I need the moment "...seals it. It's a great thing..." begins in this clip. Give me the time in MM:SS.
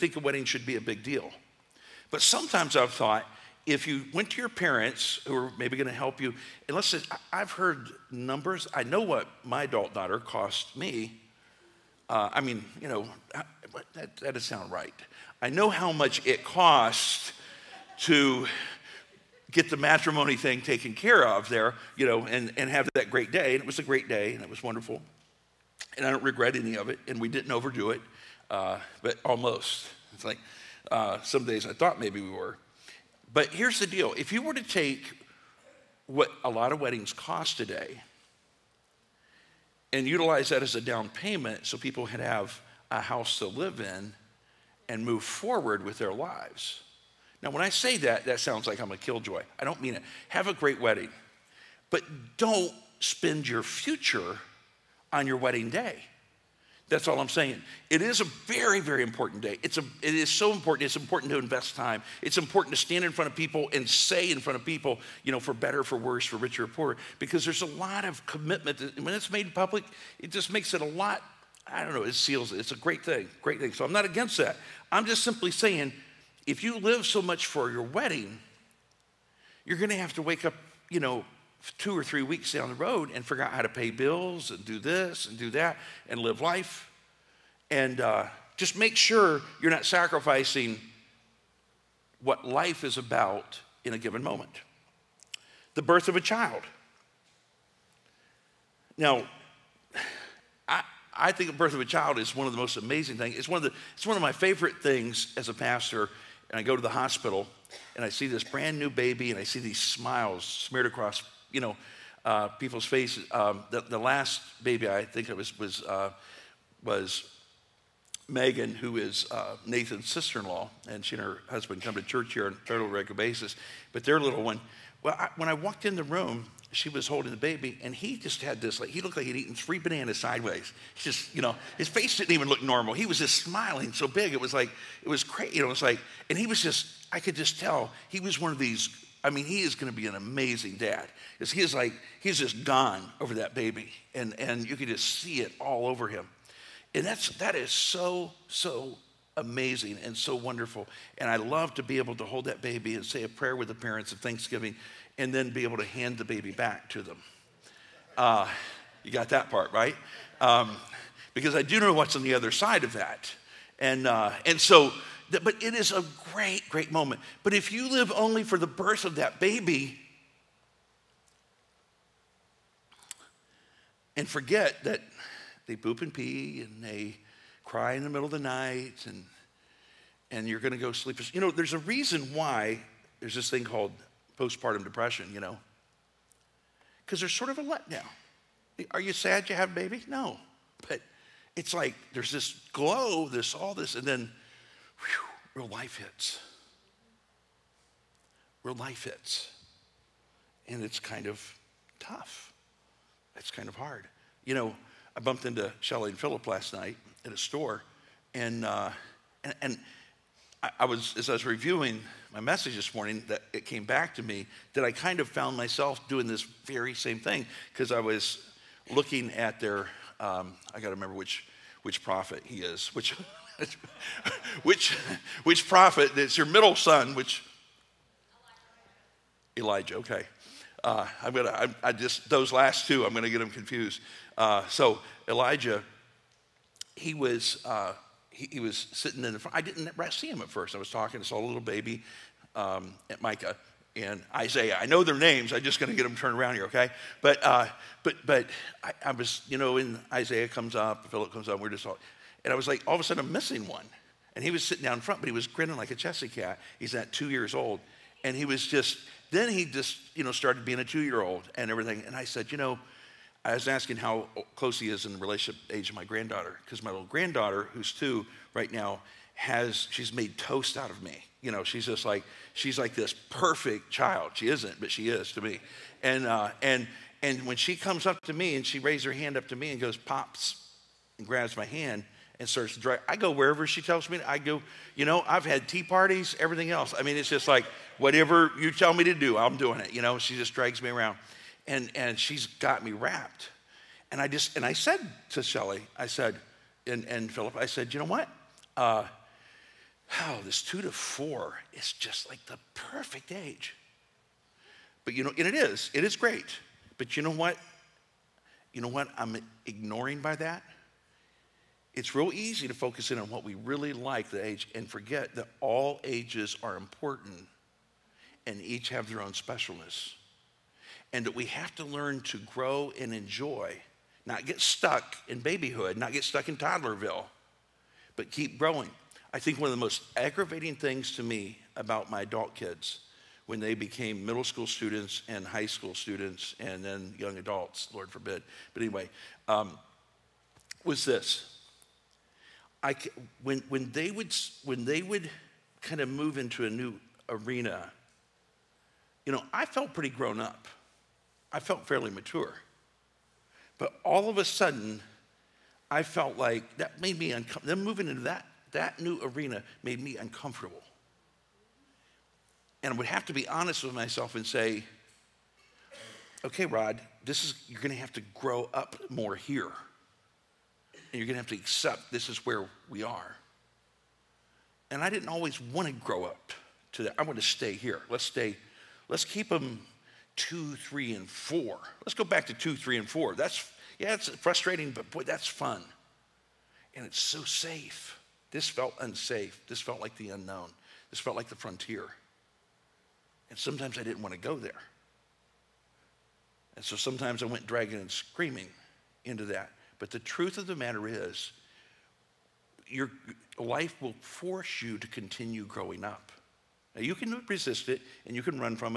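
01:12.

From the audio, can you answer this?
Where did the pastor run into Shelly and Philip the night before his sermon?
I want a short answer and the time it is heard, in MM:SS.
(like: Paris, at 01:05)
a store, at 03:27.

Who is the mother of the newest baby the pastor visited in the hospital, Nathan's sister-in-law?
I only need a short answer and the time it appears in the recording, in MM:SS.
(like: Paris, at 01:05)
Megan, at 01:58.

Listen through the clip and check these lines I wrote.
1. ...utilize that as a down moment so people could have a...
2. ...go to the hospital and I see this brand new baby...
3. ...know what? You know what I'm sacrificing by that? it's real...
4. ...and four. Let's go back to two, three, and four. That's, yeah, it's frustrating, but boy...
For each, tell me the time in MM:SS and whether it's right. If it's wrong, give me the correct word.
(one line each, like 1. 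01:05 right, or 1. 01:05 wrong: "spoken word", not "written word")
1. 00:40 wrong: "payment", not "moment"
2. 01:46 right
3. 05:07 wrong: "ignoring", not "sacrificing"
4. 06:21 right.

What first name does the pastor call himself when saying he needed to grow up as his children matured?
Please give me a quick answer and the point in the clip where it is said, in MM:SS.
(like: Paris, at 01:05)
Rod, at 06:06.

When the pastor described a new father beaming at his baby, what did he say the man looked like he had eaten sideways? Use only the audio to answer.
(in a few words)
3 bananas.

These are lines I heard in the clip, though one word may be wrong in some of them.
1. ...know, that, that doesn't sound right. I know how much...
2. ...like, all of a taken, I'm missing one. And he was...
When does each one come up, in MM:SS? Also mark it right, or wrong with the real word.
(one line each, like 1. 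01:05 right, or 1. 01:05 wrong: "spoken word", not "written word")
1. 00:12 right
2. 04:12 wrong: "sudden", not "taken".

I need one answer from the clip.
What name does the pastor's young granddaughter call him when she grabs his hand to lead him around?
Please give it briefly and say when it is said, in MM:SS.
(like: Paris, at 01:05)
Pops, at 04:39.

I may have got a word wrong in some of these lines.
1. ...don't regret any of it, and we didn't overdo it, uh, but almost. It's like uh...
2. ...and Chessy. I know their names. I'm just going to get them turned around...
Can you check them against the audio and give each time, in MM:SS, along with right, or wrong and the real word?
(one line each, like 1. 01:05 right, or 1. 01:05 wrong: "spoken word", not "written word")
1. 00:26 right
2. 04:03 wrong: "Isaiah", not "Chessy".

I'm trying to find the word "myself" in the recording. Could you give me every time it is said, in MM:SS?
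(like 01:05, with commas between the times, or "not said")
03:35, 06:03.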